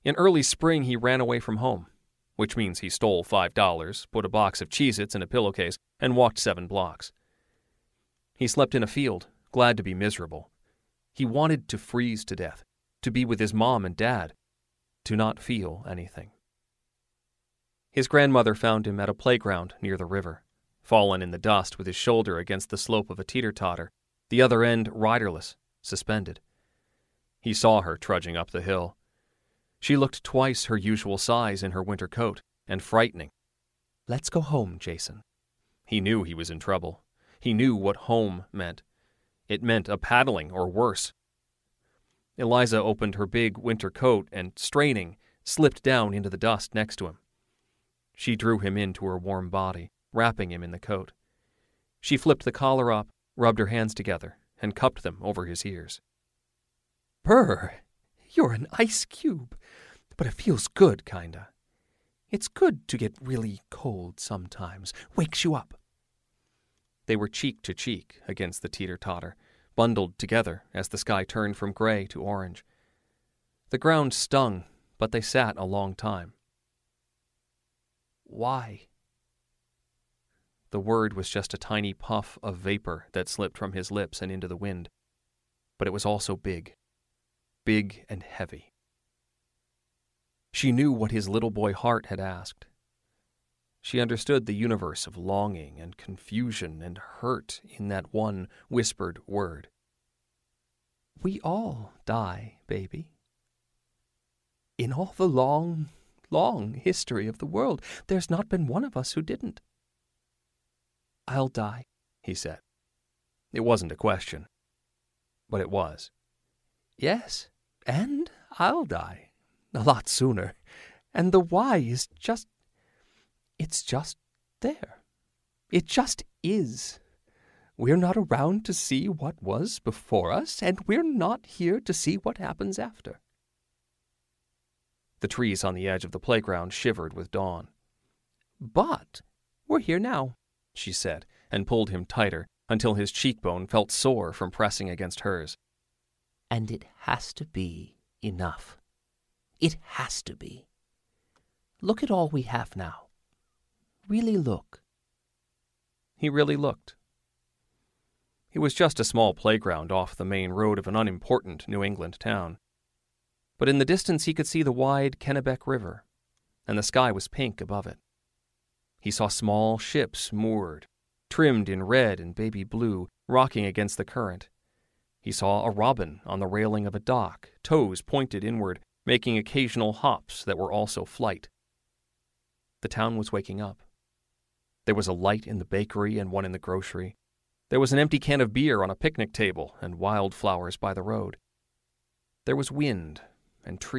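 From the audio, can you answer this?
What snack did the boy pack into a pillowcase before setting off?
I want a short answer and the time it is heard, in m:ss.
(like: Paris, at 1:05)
Cheez Its, at 0:04.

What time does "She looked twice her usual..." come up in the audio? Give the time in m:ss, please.
0:29.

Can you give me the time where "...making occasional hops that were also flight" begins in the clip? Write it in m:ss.
2:59.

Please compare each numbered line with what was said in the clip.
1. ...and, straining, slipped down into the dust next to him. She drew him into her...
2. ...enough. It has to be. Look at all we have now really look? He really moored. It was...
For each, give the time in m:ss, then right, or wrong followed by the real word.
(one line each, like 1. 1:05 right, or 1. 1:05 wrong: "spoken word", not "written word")
1. 0:44 right
2. 2:28 wrong: "looked", not "moored".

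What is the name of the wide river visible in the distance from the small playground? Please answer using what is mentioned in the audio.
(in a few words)
Kennebec River.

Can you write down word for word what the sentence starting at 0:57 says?
Brr, you're an ice cube, but it feels good, kinda.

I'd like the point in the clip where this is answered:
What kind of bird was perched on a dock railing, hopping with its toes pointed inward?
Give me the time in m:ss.
2:55.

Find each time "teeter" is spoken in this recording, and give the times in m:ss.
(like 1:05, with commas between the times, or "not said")
0:23, 1:08.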